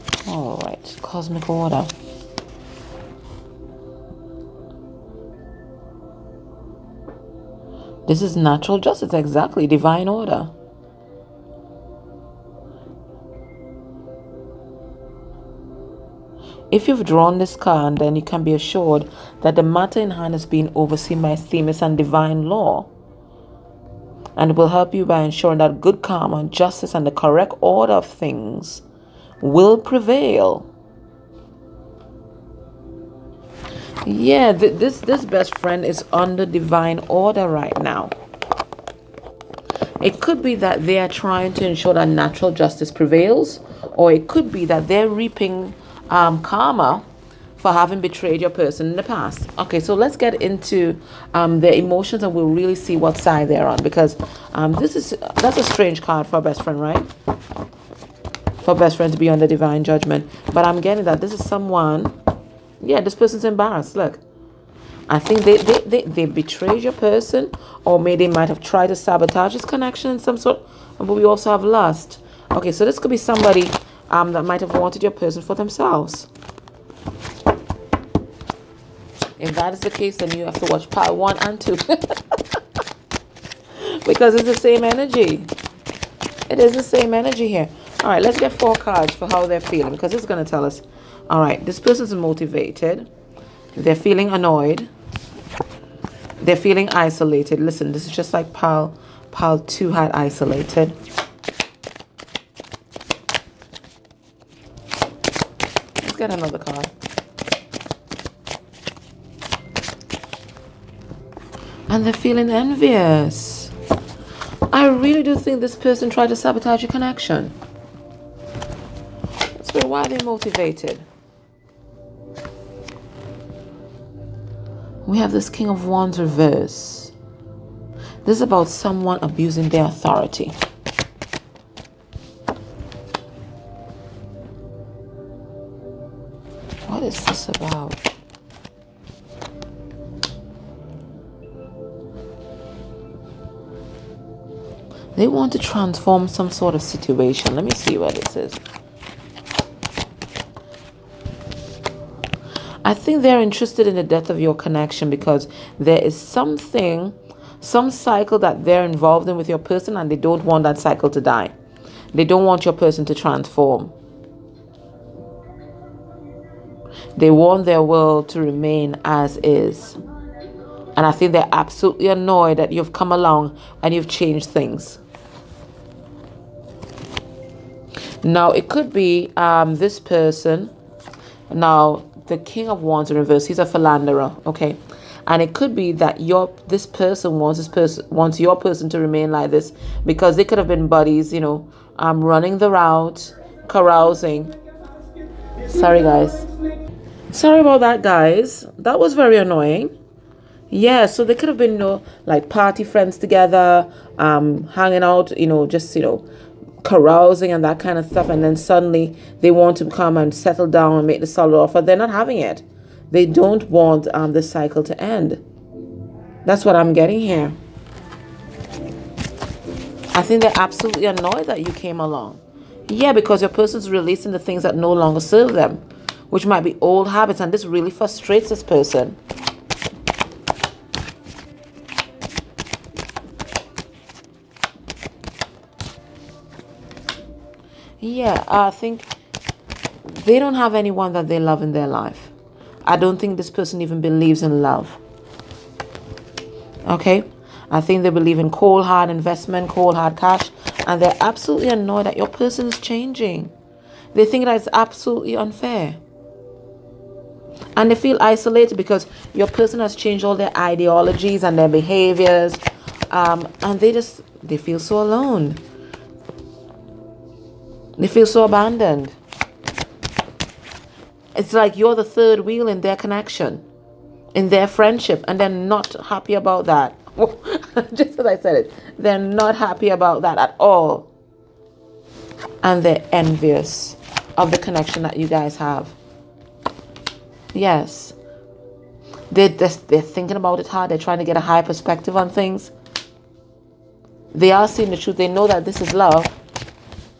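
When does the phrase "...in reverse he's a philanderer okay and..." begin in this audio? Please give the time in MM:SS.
03:03.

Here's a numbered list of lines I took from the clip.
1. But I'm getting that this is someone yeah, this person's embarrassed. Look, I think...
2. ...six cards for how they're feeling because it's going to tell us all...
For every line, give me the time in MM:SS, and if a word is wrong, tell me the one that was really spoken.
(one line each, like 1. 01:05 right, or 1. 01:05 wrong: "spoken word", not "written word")
1. 01:00 right
2. 01:28 wrong: "four", not "six".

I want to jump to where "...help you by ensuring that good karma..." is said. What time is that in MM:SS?
00:24.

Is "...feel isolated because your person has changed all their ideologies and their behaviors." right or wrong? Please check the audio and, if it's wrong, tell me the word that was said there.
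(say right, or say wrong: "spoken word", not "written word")
right.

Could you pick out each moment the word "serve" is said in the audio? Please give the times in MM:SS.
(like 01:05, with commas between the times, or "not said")
03:45.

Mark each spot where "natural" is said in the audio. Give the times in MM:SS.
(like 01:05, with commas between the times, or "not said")
00:08, 00:42.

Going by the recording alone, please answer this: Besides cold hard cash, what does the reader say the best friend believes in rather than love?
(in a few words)
Cold hard investment.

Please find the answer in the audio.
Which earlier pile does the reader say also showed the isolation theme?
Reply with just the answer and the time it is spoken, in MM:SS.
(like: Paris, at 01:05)
Pile 2, at 01:39.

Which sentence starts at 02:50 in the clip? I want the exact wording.
And I think they're absolutely annoyed that you've come along and you've changed things.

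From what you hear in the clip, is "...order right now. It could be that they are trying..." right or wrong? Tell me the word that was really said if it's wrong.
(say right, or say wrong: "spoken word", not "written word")
right.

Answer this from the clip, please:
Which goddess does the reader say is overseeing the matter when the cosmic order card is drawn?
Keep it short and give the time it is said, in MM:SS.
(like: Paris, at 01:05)
Themis, at 00:21.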